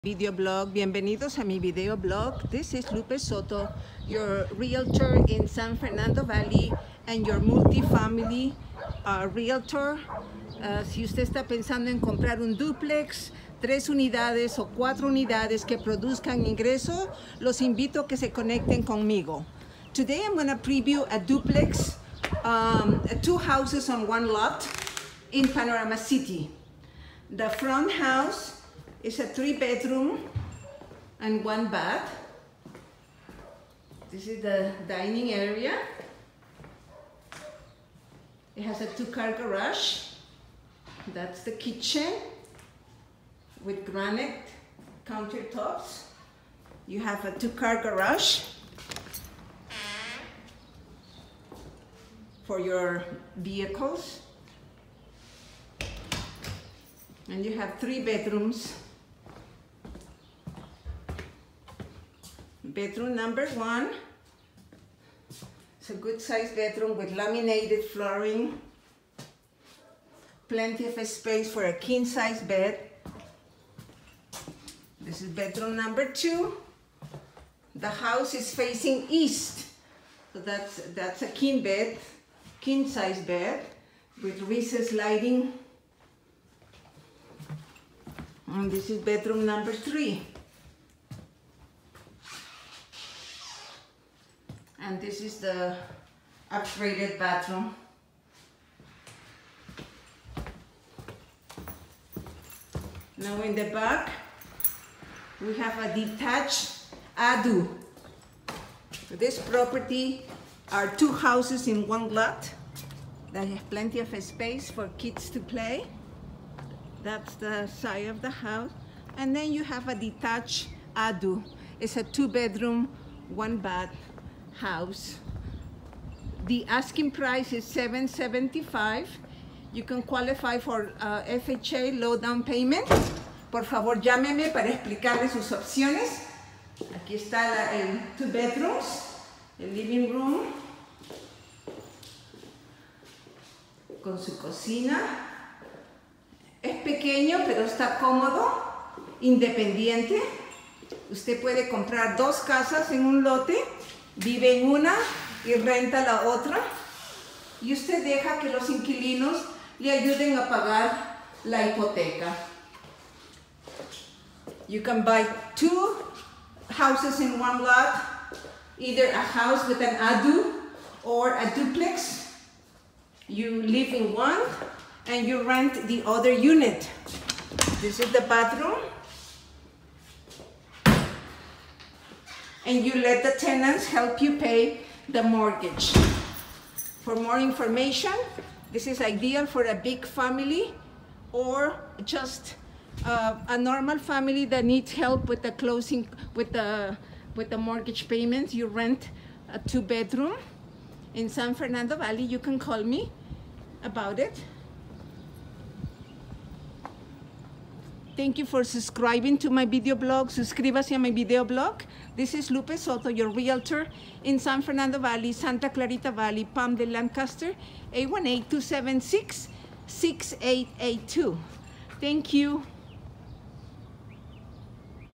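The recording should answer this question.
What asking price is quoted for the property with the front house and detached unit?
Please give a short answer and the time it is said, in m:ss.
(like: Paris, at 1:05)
775, at 2:07.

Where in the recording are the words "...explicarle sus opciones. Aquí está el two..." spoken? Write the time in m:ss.
2:14.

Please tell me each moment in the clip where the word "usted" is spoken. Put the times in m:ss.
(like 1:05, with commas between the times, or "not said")
0:11, 2:31, 2:37.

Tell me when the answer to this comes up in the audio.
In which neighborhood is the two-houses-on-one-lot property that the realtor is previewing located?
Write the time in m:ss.
0:25.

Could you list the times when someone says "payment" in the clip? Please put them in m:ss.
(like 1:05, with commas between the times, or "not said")
2:12, 3:18.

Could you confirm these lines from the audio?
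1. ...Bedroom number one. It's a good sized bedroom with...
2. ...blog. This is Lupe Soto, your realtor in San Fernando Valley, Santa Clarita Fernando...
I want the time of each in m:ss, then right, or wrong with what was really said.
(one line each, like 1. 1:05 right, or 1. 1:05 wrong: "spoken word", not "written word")
1. 1:02 right
2. 3:31 wrong: "Valley", not "Fernando".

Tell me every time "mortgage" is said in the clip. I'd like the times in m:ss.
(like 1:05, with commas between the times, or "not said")
3:05, 3:17.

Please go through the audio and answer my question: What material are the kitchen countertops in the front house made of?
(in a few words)
Granite.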